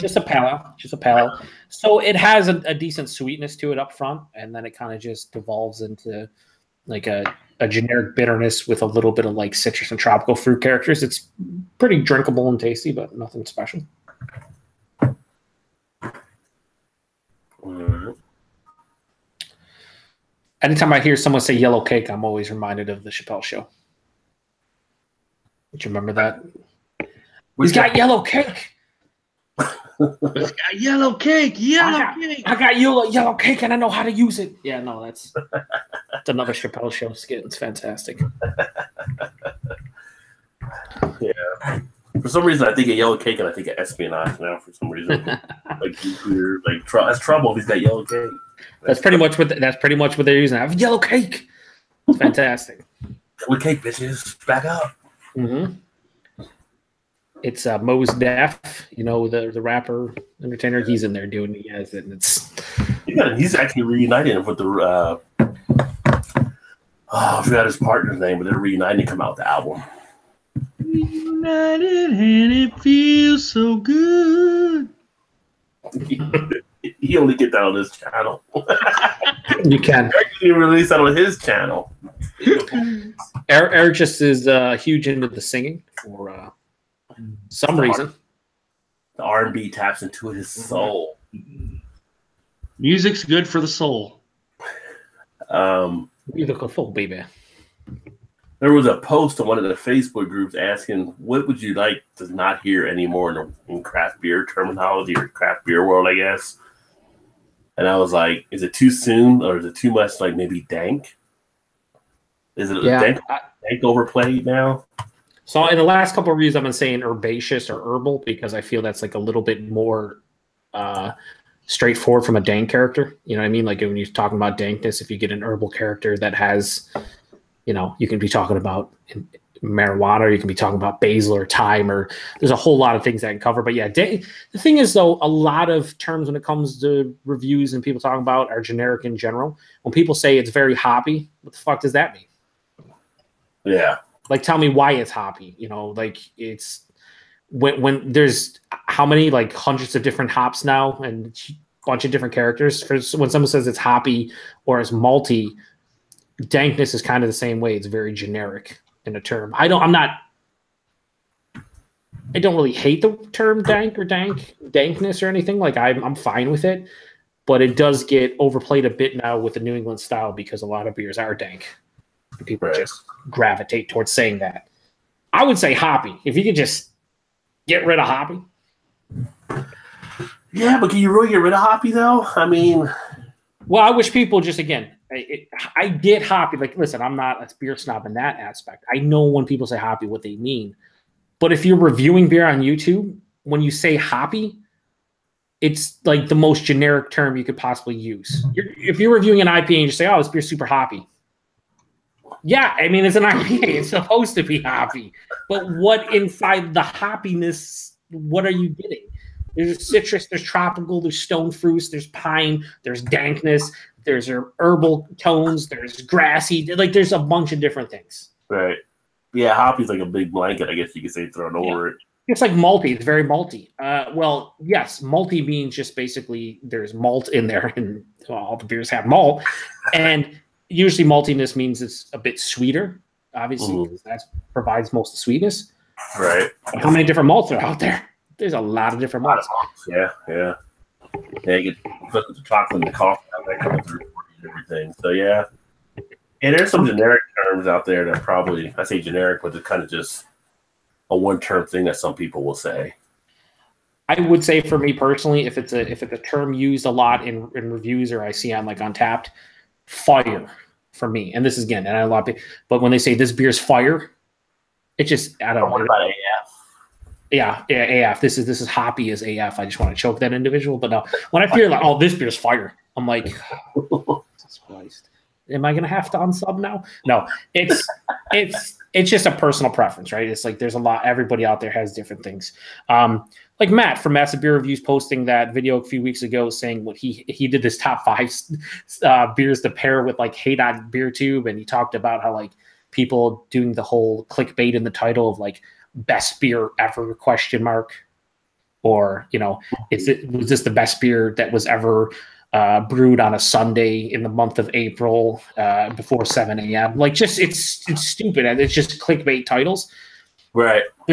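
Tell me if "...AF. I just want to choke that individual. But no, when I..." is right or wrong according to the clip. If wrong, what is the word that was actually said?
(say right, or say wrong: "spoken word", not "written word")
right.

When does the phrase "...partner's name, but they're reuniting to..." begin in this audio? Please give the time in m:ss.
1:07.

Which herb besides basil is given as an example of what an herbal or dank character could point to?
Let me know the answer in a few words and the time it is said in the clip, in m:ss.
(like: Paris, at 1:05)
Thyme, at 2:11.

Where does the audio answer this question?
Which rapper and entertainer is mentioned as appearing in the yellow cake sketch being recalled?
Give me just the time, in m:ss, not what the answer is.
0:57.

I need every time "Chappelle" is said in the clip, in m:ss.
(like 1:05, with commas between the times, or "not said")
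0:23, 0:36.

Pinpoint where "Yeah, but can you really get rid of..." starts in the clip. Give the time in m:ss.
3:00.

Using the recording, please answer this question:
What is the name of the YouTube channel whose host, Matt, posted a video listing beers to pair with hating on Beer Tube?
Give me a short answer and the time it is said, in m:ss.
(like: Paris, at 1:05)
Massive Beer Reviews, at 4:44.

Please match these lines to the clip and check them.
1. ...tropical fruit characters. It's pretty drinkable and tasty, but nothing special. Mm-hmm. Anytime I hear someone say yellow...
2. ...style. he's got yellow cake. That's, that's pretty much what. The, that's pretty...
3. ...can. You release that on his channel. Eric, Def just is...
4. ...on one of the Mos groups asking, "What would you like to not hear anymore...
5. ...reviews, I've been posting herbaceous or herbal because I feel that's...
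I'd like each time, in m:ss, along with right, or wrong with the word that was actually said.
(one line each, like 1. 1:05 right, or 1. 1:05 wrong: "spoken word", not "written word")
1. 0:09 right
2. 0:47 wrong: "trouble", not "style"
3. 1:19 wrong: "Eric", not "Def"
4. 1:39 wrong: "Facebook", not "Mos"
5. 1:56 wrong: "saying", not "posting".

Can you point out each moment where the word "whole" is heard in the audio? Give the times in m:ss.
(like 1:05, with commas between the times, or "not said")
2:12, 4:53.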